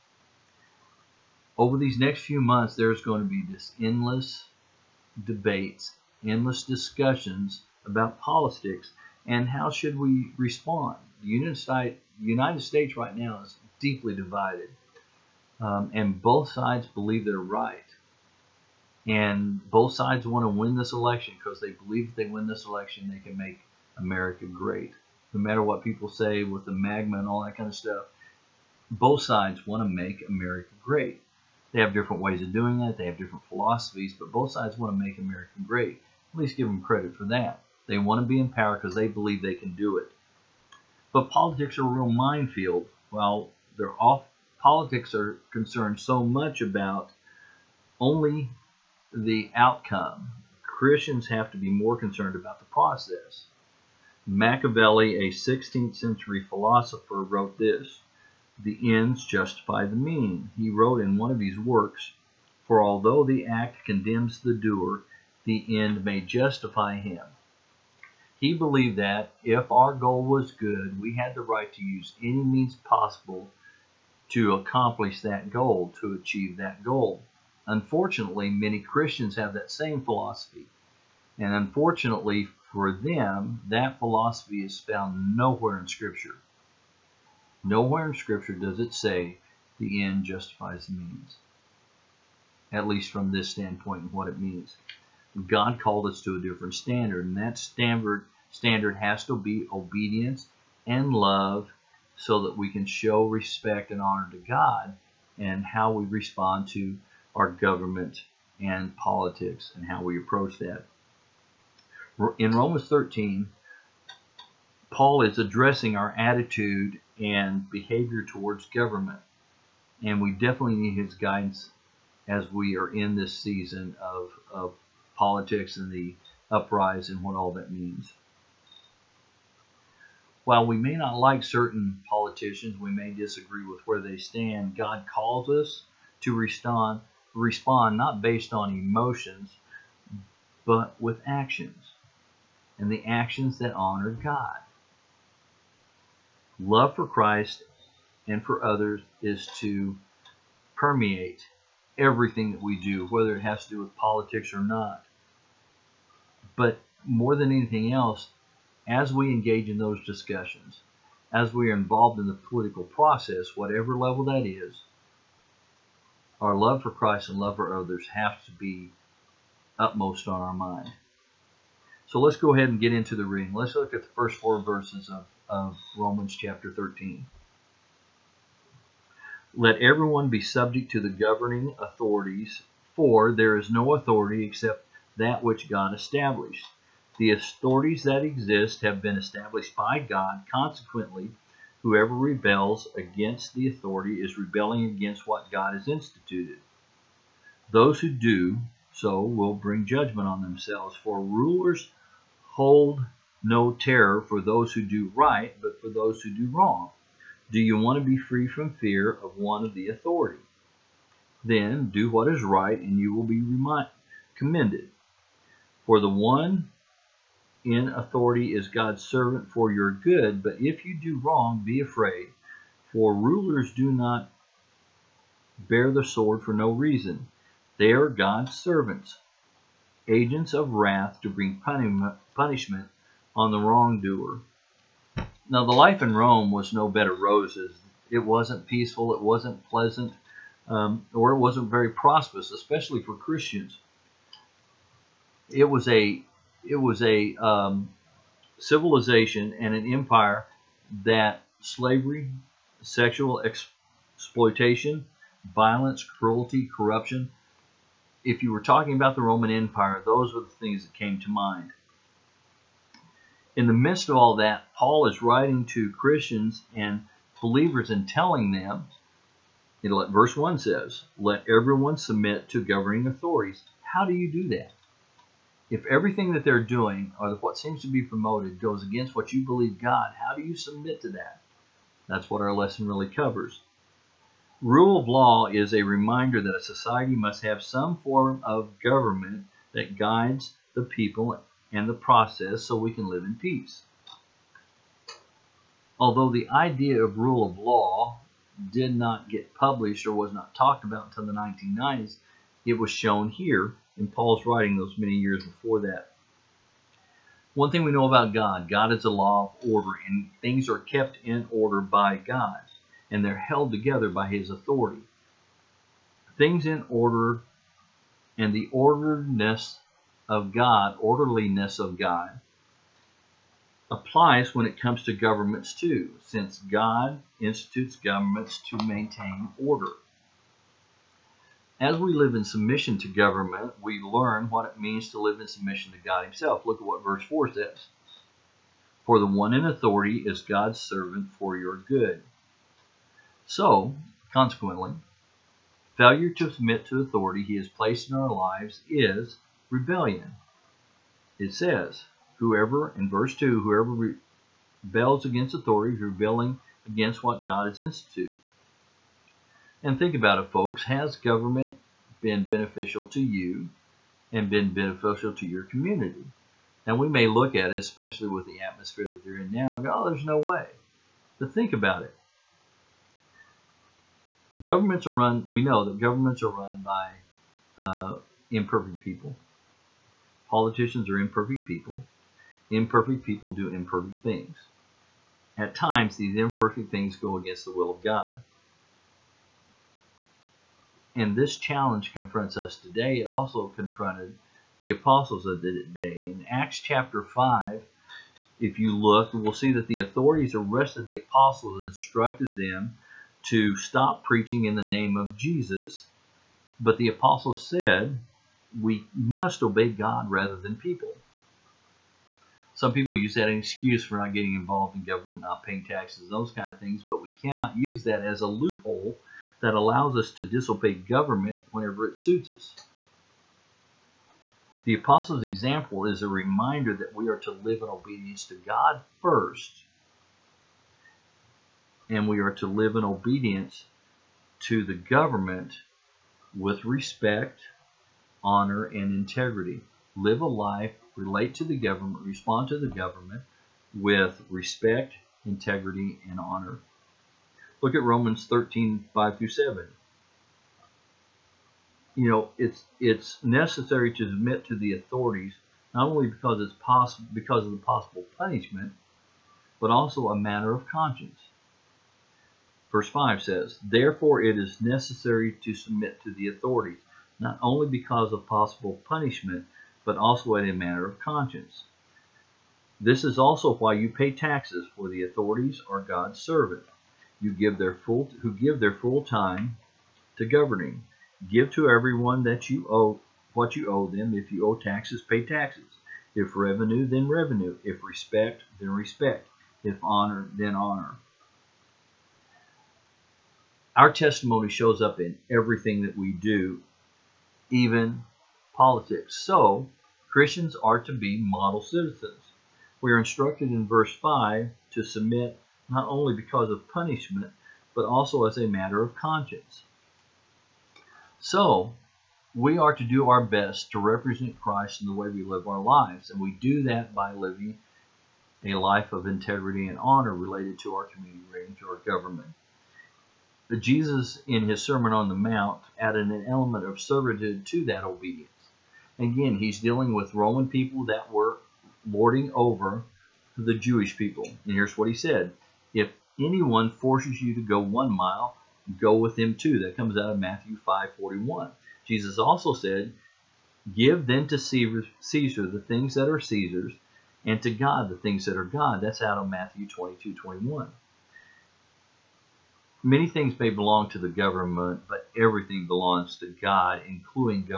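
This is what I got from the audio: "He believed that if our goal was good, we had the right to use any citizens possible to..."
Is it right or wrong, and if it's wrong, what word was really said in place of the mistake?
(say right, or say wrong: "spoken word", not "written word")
wrong: "means", not "citizens".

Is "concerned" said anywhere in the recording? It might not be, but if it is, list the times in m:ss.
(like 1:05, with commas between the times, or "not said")
0:45, 0:51.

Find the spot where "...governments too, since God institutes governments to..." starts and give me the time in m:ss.
5:25.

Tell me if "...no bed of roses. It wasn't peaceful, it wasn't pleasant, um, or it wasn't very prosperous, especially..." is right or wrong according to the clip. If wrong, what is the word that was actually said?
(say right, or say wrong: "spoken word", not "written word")
right.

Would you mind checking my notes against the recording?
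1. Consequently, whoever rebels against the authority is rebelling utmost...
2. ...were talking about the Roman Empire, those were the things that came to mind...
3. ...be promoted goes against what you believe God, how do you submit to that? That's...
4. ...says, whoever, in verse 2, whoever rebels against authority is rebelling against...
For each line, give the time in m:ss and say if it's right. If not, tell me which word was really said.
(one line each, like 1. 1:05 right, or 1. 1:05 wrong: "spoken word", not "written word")
1. 3:10 wrong: "against", not "utmost"
2. 4:18 right
3. 4:37 right
4. 5:51 right.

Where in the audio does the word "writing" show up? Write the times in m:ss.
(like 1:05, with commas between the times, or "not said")
4:25, 5:04.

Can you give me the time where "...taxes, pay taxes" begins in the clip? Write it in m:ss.
8:04.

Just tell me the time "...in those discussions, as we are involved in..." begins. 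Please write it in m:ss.
2:39.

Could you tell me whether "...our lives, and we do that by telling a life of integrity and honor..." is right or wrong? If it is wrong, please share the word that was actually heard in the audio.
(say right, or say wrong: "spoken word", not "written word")
wrong: "living", not "telling".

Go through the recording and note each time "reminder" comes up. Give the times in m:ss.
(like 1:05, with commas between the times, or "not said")
4:45, 7:06.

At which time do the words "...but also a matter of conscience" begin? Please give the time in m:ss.
7:39.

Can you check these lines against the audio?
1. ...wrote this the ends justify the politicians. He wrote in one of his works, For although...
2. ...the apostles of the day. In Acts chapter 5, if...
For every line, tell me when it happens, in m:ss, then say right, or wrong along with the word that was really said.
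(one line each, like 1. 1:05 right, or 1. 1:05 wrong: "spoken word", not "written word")
1. 0:57 wrong: "means", not "politicians"
2. 6:34 right.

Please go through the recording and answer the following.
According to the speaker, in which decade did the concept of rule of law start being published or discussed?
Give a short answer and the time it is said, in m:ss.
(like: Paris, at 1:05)
1990s, at 5:01.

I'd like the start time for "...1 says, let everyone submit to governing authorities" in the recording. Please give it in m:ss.
4:30.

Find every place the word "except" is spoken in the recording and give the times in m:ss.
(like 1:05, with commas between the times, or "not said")
3:04.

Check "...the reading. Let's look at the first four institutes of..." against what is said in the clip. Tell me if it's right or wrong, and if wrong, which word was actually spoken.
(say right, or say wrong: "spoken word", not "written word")
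wrong: "verses", not "institutes".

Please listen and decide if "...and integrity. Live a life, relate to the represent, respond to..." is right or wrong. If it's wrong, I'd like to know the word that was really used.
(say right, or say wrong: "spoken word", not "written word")
wrong: "government", not "represent".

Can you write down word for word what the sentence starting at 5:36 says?
Look at what verse 4 says.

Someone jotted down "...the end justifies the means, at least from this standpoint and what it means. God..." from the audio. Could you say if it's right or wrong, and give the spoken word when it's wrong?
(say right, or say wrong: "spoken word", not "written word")
right.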